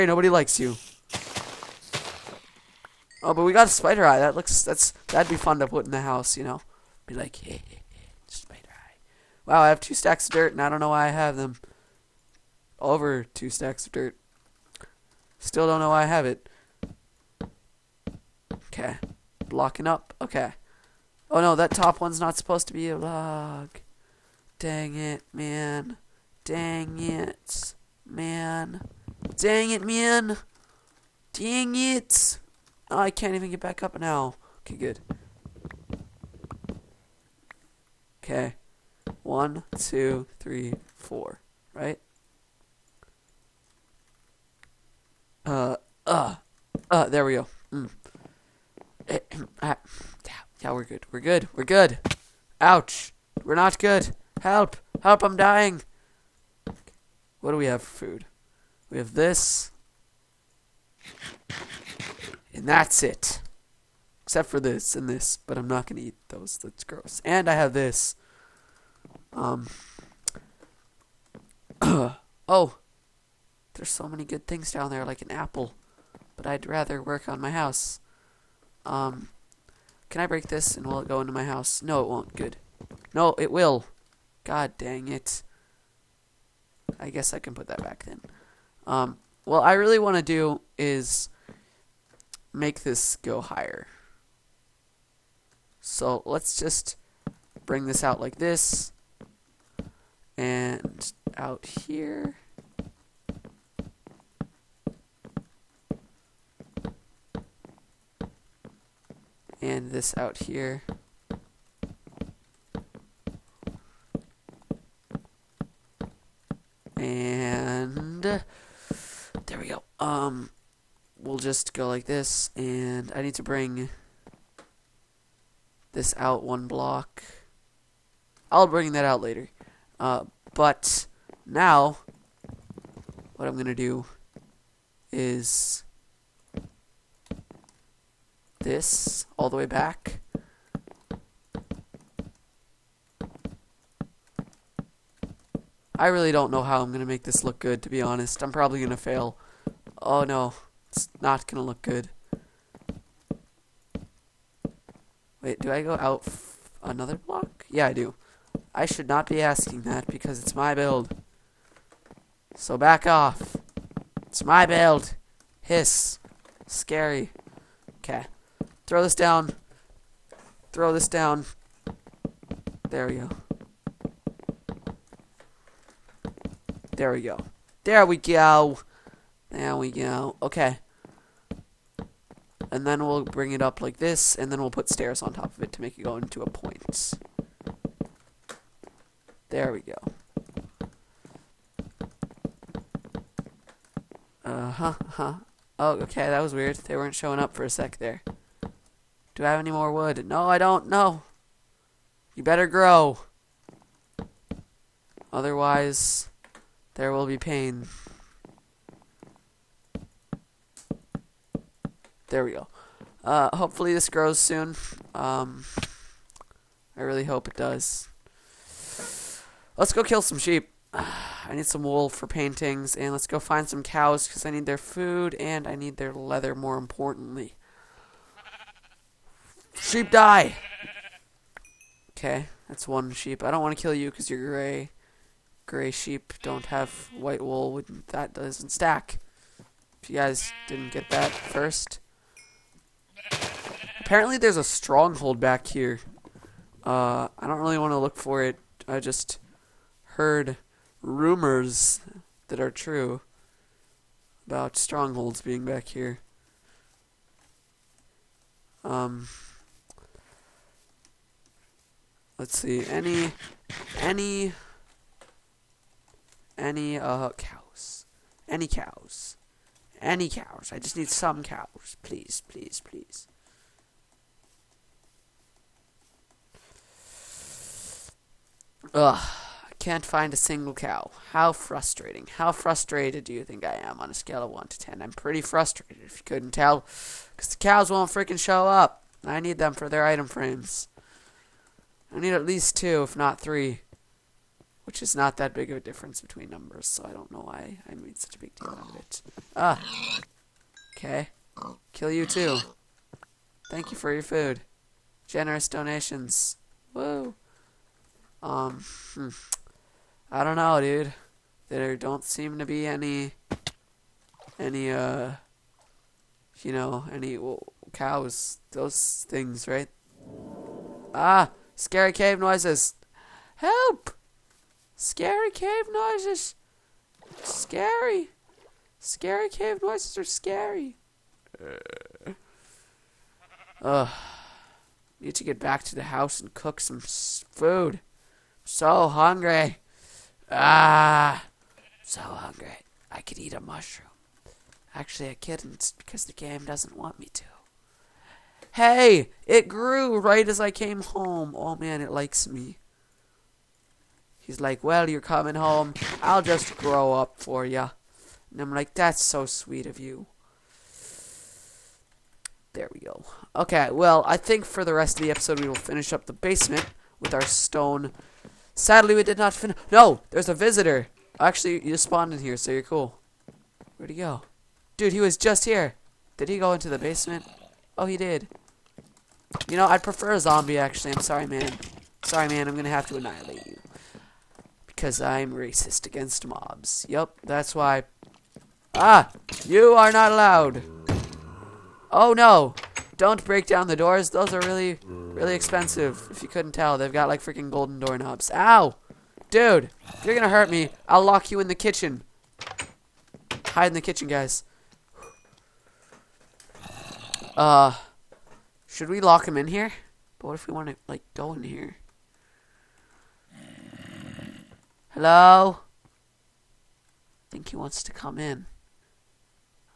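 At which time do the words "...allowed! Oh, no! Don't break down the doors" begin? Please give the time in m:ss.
6:30.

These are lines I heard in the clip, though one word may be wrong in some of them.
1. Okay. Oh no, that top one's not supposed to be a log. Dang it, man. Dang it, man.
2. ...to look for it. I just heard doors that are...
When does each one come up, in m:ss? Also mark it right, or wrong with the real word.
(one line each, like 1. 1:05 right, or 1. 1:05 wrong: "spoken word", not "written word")
1. 0:20 right
2. 4:07 wrong: "rumors", not "doors".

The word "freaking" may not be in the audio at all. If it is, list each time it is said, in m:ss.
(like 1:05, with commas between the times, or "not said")
4:48, 6:37.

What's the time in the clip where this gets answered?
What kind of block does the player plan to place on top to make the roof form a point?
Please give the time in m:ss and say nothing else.
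3:04.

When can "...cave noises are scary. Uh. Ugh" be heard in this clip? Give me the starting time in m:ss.
5:29.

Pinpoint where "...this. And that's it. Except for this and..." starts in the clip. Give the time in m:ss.
0:59.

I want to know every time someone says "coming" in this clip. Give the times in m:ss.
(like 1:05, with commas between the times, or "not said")
5:55.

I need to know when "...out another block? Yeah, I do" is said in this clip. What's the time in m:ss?
2:35.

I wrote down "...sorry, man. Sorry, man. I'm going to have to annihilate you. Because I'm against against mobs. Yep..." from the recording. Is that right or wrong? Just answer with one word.
wrong.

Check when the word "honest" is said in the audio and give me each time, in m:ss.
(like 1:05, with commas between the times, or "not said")
2:27.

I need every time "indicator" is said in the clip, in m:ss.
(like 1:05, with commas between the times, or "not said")
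not said.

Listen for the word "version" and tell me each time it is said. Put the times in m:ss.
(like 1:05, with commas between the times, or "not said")
not said.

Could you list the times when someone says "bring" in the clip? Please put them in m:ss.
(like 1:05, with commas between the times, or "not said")
1:37, 2:03, 2:08, 3:03.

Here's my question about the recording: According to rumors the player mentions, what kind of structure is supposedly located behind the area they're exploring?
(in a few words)
A stronghold.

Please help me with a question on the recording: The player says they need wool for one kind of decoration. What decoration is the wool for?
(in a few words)
Paintings.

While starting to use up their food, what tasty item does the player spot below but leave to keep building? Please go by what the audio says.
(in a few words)
An apple.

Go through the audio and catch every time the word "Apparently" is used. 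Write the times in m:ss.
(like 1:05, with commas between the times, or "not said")
4:03.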